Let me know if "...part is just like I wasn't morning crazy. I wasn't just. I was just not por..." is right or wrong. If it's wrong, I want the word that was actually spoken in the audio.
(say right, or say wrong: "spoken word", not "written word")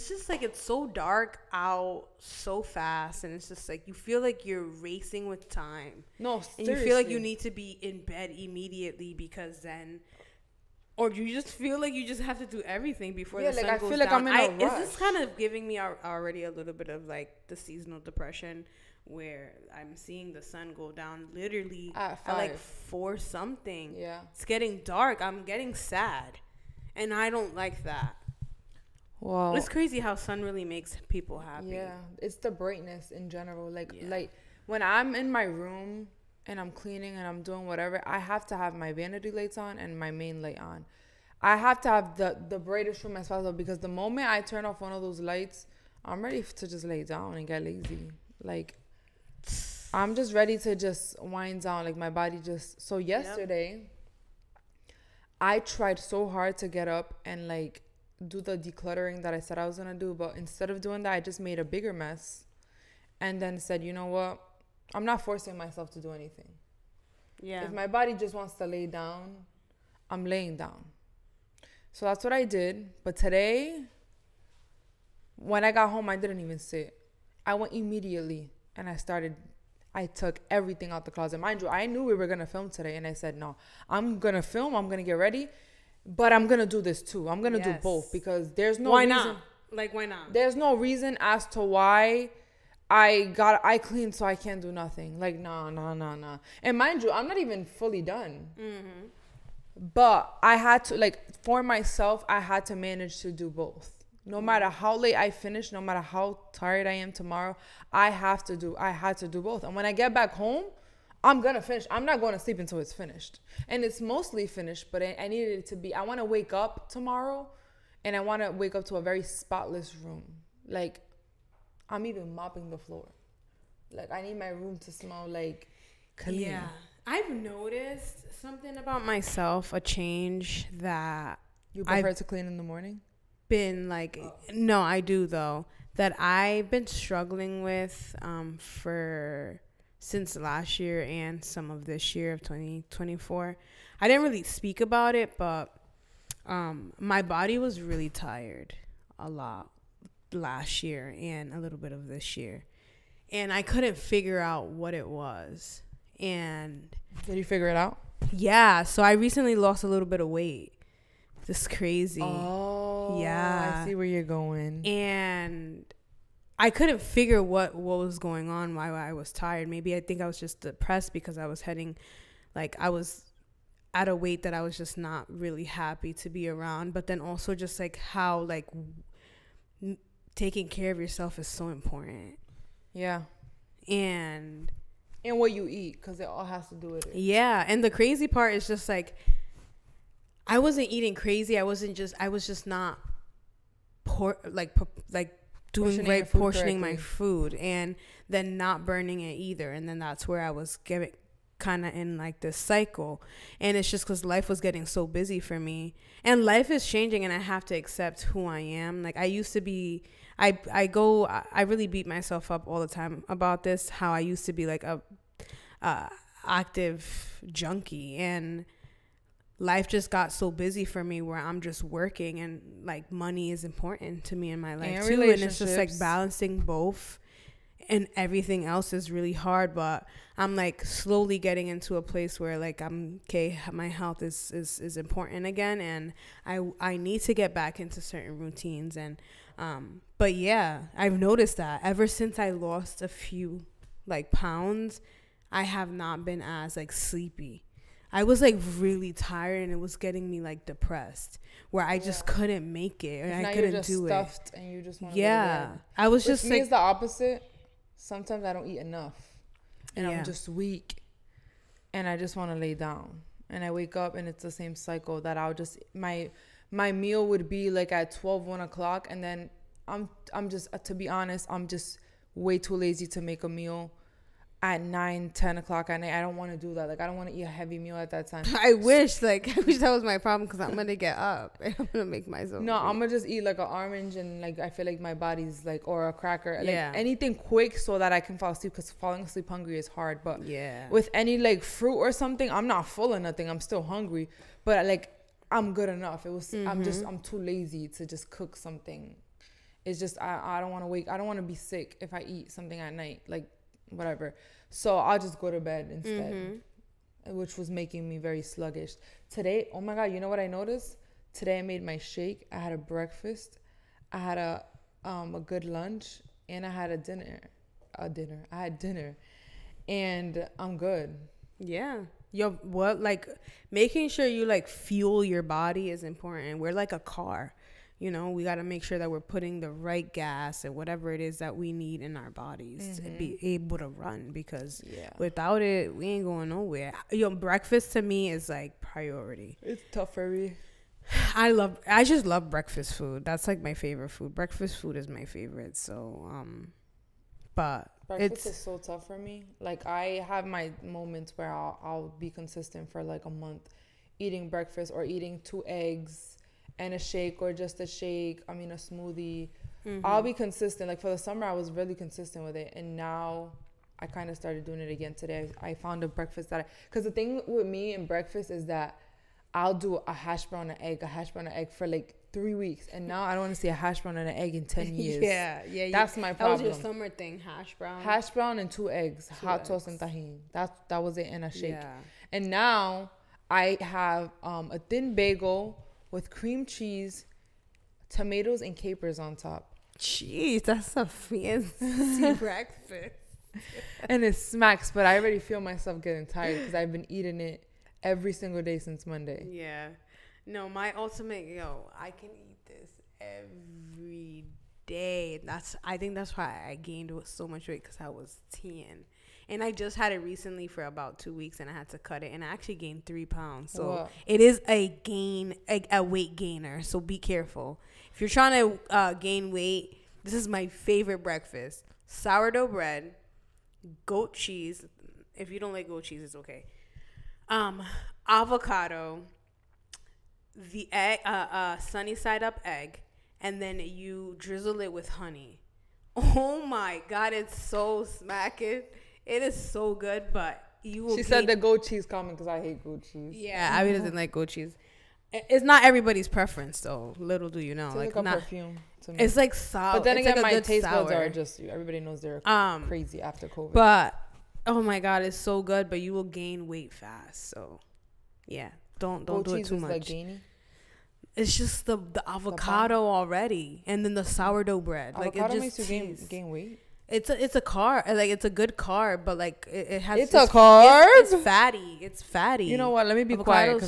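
wrong: "eating", not "morning".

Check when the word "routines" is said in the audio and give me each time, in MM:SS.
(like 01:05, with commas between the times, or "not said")
03:58.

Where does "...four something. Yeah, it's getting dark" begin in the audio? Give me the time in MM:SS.
00:22.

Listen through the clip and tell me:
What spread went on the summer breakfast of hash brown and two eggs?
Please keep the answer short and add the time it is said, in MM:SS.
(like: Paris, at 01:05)
tahini, at 06:20.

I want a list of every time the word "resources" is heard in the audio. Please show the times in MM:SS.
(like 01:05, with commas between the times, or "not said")
not said.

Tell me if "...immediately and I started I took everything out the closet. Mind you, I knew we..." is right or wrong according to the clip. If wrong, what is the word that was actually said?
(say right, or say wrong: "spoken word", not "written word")
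right.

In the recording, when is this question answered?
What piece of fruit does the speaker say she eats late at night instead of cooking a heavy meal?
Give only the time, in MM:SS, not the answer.
04:43.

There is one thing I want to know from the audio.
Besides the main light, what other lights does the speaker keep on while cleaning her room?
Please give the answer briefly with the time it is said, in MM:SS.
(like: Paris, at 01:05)
vanity lights, at 00:38.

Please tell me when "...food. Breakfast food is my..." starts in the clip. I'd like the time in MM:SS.
05:44.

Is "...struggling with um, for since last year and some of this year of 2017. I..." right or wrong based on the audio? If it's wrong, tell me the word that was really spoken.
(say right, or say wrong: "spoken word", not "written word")
wrong: "2024", not "2017".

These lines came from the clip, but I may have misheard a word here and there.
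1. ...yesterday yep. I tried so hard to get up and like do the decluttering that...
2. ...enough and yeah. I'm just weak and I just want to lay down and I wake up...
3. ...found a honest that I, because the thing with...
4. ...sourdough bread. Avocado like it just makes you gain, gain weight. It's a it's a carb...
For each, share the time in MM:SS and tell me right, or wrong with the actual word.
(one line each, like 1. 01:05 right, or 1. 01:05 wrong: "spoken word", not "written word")
1. 00:52 right
2. 04:18 right
3. 06:05 wrong: "breakfast", not "honest"
4. 07:44 right.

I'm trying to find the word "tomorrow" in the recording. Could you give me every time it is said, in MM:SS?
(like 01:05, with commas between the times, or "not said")
01:47, 01:56.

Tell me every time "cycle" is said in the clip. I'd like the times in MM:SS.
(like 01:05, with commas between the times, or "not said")
03:22, 04:24.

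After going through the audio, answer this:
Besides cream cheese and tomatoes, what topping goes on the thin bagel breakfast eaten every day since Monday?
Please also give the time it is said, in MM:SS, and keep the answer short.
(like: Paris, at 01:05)
capers, at 06:28.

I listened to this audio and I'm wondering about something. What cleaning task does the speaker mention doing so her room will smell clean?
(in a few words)
mopping the floor.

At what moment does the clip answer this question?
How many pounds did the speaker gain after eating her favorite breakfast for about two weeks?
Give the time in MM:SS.
06:53.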